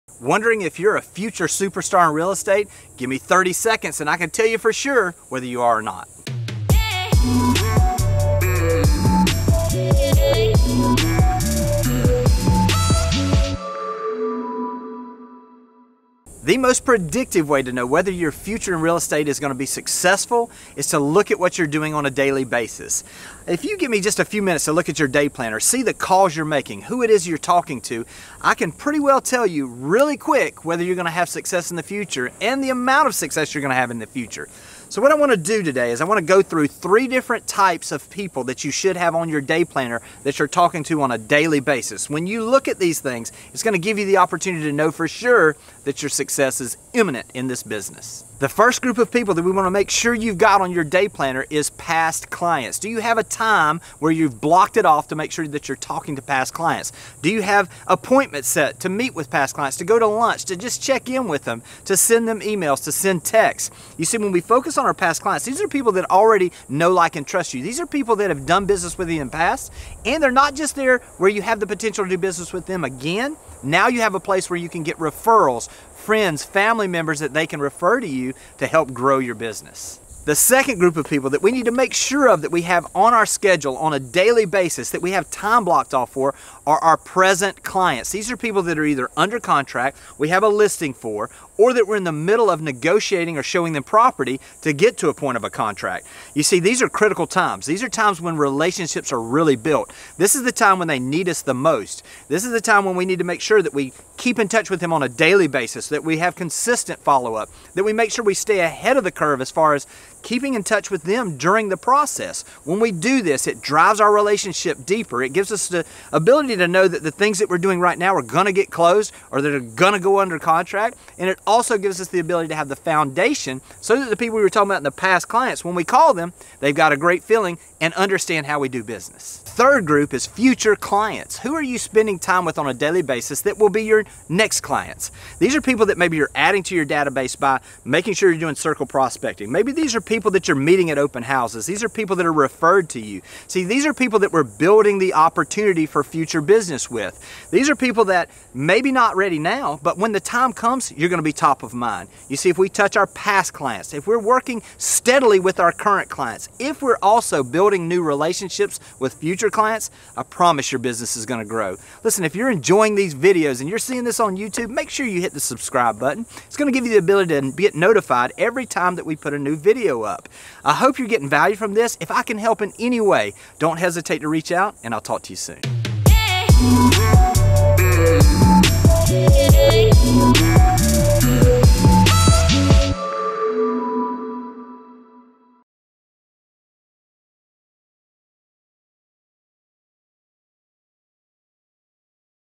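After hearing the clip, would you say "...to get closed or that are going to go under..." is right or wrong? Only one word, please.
right.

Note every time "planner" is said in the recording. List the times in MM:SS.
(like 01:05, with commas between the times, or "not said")
00:25, 00:39, 00:51.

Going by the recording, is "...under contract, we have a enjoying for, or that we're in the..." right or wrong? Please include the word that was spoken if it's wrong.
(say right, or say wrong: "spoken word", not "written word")
wrong: "listing", not "enjoying".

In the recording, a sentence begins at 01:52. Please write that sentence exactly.
When we do this, it drives our relationship deeper.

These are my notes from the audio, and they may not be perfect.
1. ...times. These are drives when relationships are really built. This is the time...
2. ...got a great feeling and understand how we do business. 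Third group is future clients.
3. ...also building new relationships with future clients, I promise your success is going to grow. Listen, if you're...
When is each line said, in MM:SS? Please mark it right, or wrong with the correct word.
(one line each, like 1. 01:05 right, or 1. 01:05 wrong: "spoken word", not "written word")
1. 01:37 wrong: "times", not "drives"
2. 02:06 right
3. 02:37 wrong: "business", not "success".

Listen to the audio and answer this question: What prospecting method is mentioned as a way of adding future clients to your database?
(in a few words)
Circle prospecting.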